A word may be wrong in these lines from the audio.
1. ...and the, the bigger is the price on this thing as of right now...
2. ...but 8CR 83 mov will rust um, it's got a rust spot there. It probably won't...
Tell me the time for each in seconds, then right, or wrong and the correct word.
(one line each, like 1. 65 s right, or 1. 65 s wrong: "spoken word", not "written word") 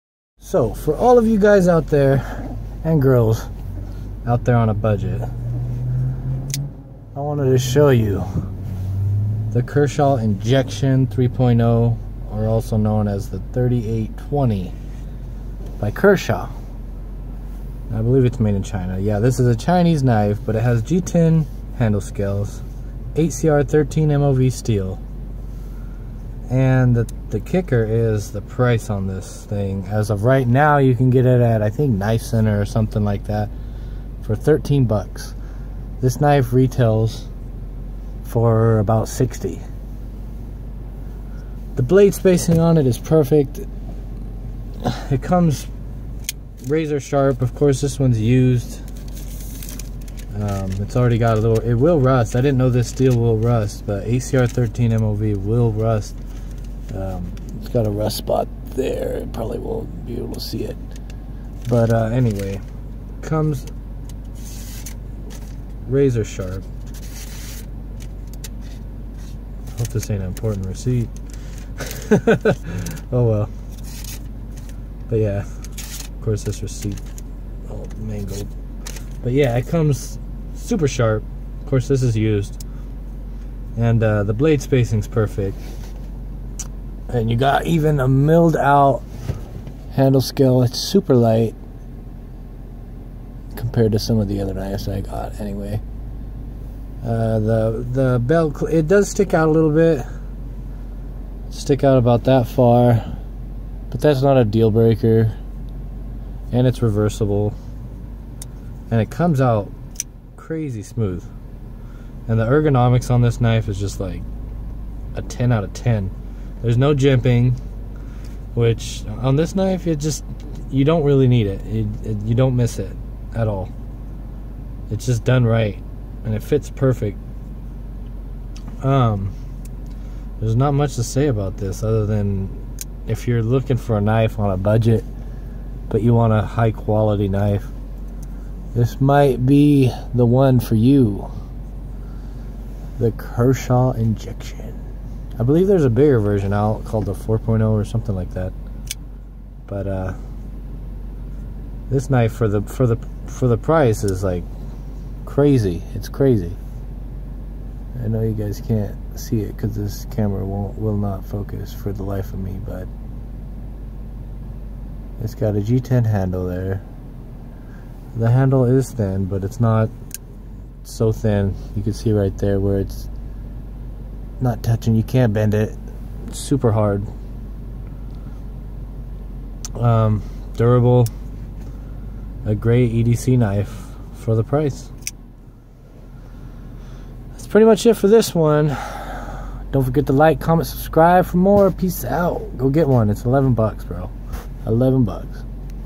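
1. 26 s wrong: "kicker", not "bigger"
2. 53 s wrong: "13", not "83".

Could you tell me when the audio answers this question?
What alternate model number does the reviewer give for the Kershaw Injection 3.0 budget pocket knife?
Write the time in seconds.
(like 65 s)
13 s.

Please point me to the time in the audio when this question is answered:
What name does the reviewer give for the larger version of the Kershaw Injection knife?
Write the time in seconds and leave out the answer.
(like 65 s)
147 s.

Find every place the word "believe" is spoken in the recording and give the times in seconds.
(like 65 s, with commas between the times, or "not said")
18 s, 145 s.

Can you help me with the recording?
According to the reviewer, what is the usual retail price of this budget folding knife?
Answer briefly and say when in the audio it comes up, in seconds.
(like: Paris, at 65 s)
$60, at 38 s.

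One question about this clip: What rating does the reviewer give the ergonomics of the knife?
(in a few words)
10 out of 10.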